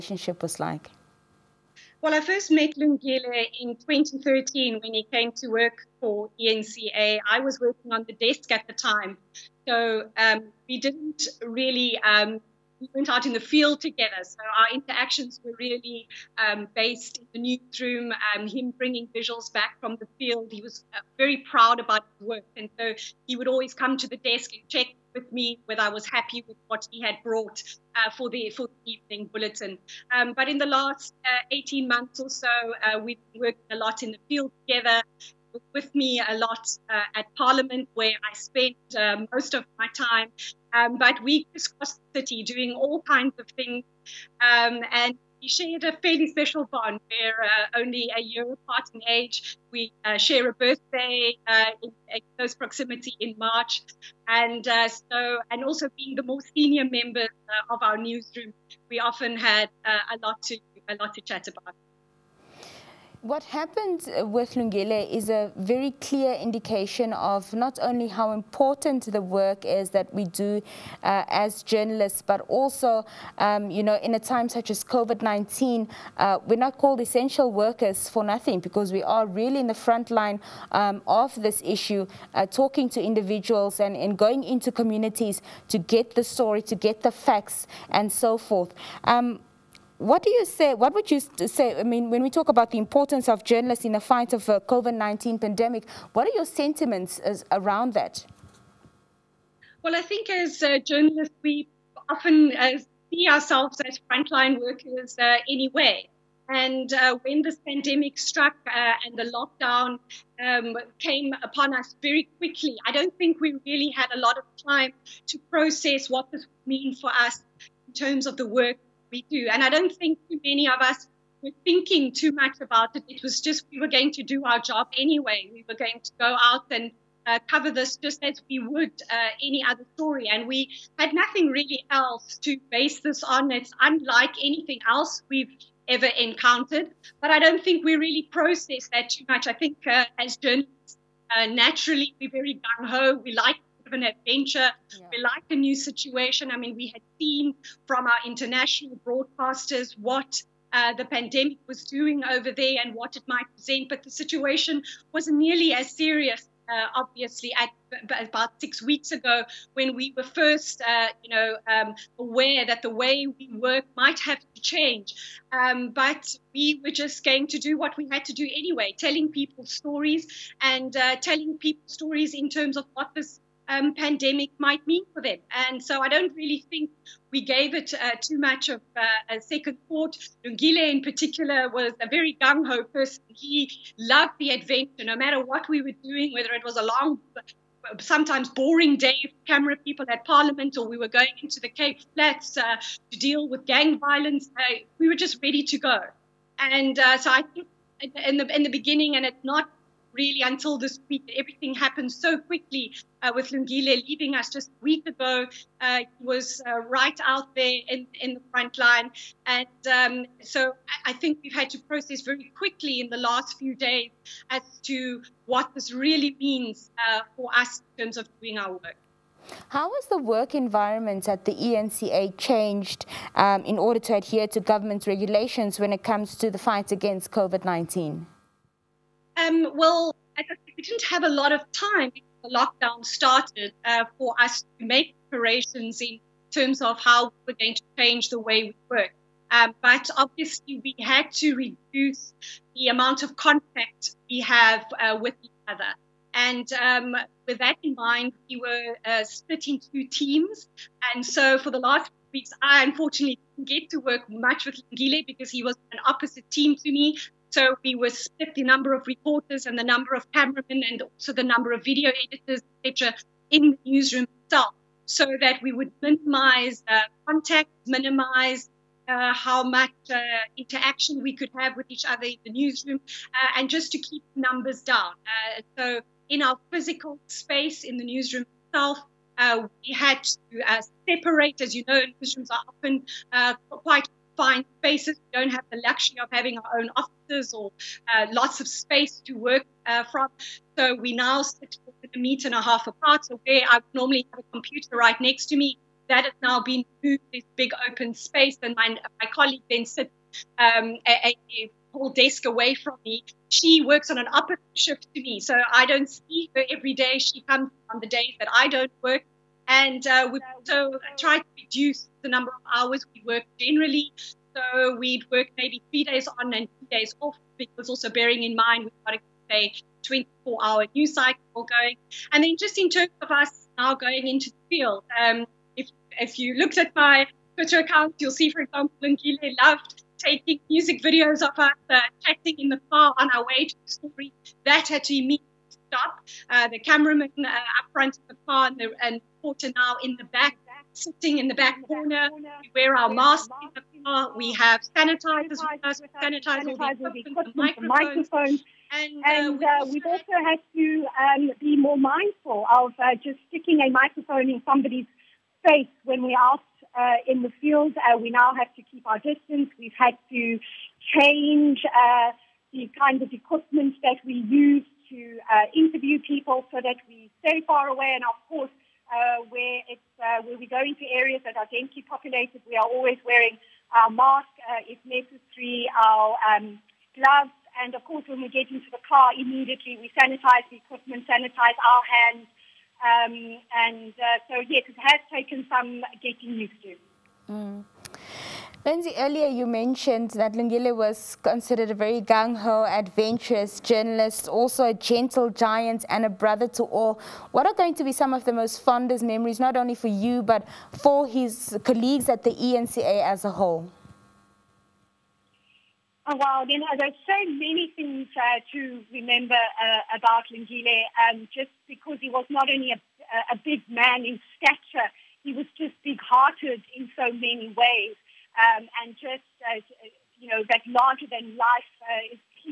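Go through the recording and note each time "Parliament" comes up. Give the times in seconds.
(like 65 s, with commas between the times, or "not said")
37 s, 190 s.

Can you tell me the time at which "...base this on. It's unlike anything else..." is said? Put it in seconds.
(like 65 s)
132 s.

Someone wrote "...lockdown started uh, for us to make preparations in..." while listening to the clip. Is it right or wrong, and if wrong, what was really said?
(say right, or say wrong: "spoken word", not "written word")
right.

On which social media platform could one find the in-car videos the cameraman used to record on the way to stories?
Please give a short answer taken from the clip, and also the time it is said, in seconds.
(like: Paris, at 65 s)
Twitter, at 327 s.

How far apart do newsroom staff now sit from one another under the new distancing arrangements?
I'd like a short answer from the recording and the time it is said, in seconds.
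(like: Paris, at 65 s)
a meter and a half, at 292 s.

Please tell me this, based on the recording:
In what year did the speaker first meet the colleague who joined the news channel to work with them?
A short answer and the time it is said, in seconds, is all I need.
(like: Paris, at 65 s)
2013, at 3 s.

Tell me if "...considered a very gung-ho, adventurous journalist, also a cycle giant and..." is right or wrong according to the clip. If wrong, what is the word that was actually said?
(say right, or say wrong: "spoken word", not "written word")
wrong: "gentle", not "cycle".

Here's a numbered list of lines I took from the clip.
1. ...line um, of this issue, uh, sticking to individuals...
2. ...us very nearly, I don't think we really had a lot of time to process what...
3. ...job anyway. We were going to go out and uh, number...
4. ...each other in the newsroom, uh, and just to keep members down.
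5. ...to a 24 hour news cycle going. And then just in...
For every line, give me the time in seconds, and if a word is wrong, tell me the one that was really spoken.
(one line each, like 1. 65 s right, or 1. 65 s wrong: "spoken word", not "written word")
1. 80 s wrong: "talking", not "sticking"
2. 111 s wrong: "quickly", not "nearly"
3. 124 s wrong: "cover", not "number"
4. 271 s wrong: "numbers", not "members"
5. 319 s right.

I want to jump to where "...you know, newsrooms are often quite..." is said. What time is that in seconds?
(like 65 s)
281 s.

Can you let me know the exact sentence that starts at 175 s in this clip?
And so I don't really think we gave it uh, too much of uh, a second thought.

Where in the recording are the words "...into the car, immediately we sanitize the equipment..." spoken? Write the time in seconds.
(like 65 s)
378 s.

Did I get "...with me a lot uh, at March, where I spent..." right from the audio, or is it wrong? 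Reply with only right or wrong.
wrong.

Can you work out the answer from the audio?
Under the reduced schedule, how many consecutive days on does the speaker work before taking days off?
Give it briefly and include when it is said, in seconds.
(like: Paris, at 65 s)
3, at 315 s.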